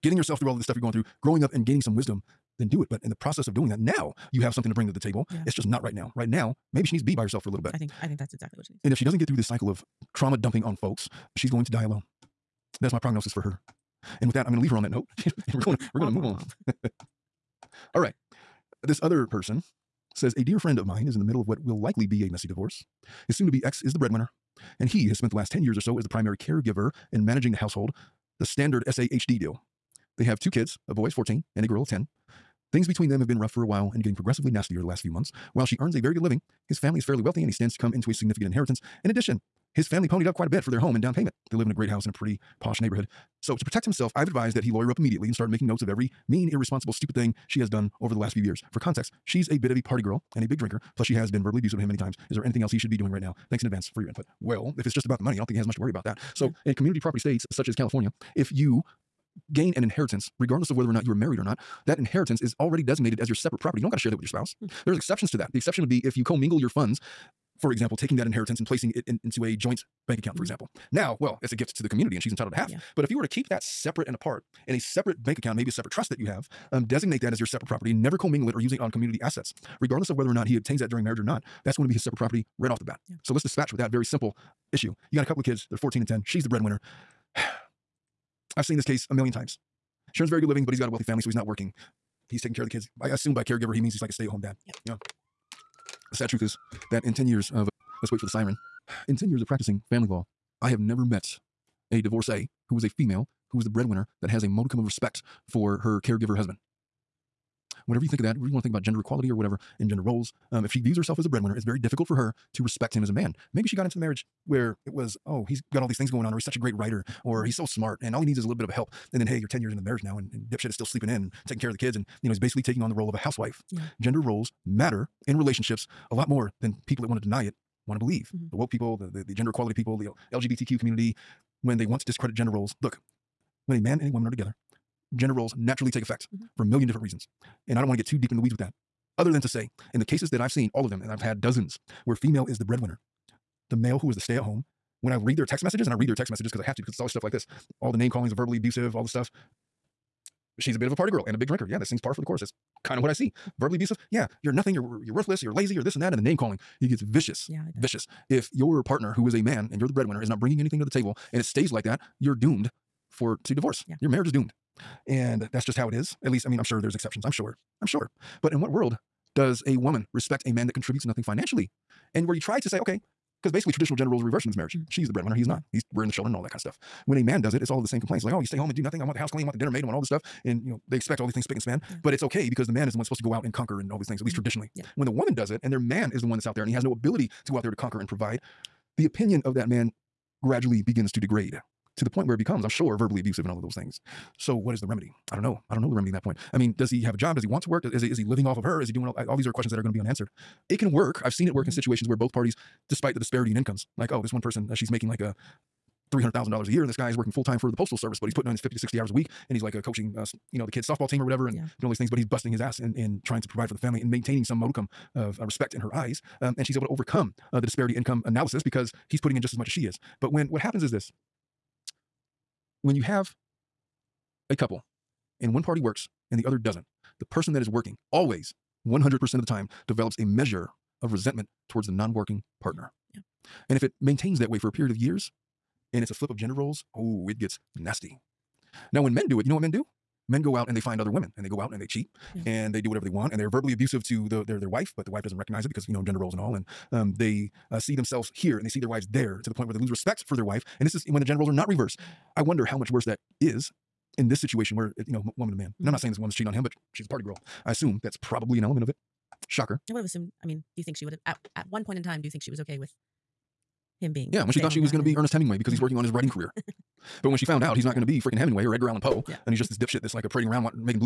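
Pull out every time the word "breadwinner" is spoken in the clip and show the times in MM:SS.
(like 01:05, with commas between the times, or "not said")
00:23, 01:26, 01:43, 01:51, 02:22, 02:39, 02:55.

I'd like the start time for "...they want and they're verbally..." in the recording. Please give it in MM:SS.
04:03.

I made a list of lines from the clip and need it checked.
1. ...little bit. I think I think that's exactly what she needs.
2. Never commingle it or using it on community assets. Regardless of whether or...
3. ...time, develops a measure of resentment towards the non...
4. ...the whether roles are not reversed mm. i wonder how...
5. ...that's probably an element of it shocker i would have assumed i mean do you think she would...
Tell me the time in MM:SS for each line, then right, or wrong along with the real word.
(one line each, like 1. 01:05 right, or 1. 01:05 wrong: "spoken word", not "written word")
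1. 00:07 right
2. 01:17 right
3. 03:49 right
4. 04:11 wrong: "gender", not "whether"
5. 04:18 right.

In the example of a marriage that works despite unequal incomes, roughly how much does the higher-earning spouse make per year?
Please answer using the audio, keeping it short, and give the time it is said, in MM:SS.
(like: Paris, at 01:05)
$300,000, at 03:26.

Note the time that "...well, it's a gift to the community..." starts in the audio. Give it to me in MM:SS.
01:11.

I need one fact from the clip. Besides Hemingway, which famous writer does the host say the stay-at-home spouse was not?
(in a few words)
Edgar Allan Poe.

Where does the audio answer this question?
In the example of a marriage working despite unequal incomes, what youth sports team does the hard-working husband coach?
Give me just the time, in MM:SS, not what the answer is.
03:30.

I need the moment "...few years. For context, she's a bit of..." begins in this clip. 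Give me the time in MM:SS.
00:48.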